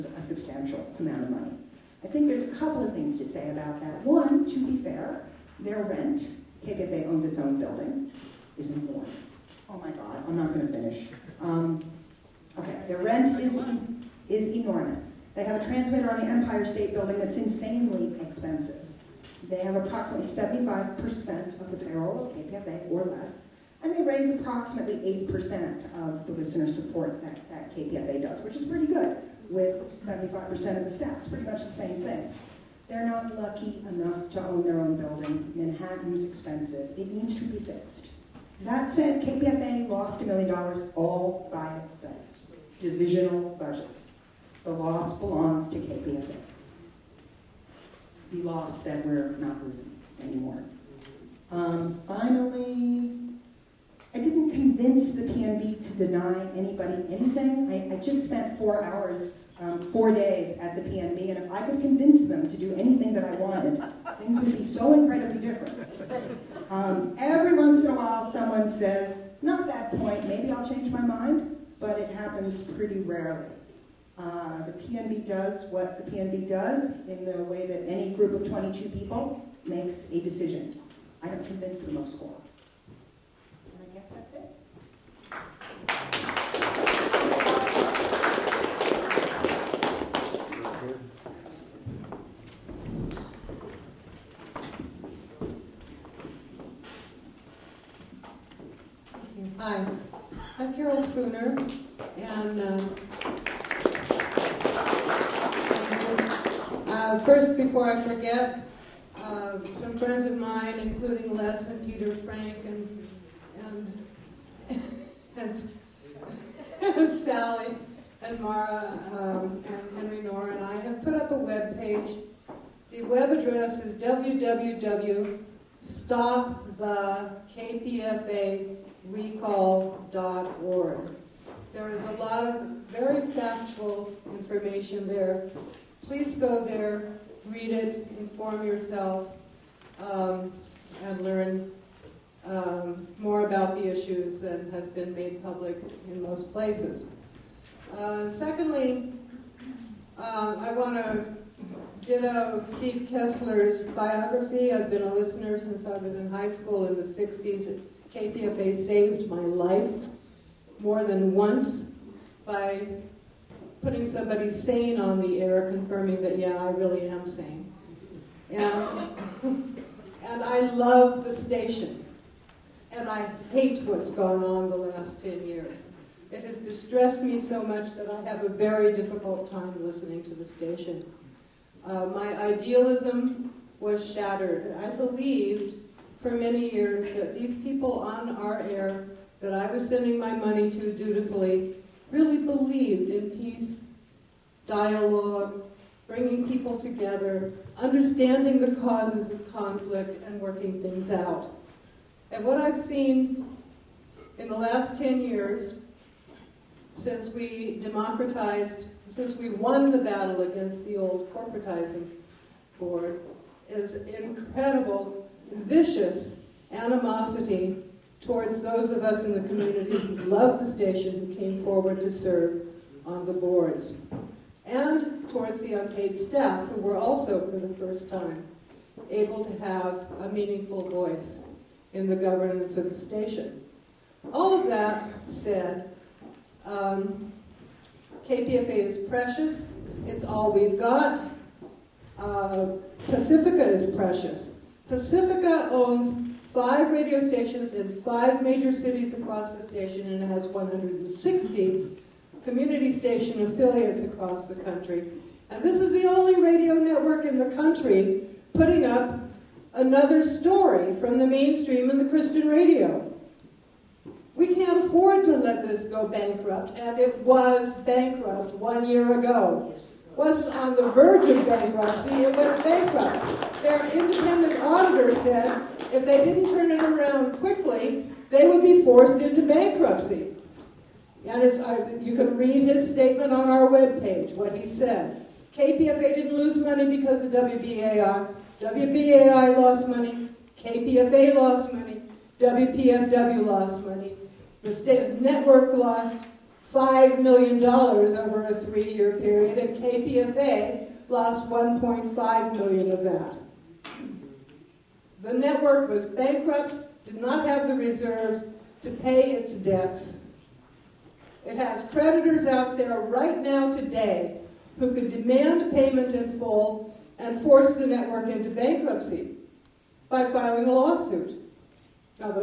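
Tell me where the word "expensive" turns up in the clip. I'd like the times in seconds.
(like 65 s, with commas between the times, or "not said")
18 s, 36 s.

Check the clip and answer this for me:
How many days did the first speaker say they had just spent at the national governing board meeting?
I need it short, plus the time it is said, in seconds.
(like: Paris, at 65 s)
4, at 59 s.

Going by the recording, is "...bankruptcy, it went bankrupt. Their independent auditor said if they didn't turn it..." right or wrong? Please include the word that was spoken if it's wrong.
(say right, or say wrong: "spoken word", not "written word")
right.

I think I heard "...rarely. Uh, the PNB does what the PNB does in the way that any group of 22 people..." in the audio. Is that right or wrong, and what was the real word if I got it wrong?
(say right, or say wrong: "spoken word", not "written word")
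right.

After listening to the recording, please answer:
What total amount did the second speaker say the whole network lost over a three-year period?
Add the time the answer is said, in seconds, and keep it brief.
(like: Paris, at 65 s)
$5 million, at 296 s.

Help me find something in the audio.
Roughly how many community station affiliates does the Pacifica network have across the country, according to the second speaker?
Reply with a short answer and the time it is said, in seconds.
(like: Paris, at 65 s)
160, at 250 s.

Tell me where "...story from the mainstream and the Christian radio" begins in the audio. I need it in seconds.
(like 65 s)
260 s.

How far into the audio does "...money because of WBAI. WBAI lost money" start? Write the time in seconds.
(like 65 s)
286 s.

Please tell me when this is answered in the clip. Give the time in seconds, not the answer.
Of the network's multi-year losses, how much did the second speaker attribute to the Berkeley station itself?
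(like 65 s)
301 s.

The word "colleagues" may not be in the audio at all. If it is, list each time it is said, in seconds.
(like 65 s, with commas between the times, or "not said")
not said.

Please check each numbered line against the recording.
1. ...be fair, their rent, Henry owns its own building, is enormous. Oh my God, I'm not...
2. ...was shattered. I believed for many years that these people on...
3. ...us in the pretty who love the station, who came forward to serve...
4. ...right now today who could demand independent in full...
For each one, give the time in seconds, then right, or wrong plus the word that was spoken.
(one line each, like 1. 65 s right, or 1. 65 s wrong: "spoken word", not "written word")
1. 4 s wrong: "KPFA", not "Henry"
2. 183 s right
3. 219 s wrong: "community", not "pretty"
4. 312 s wrong: "payment", not "independent".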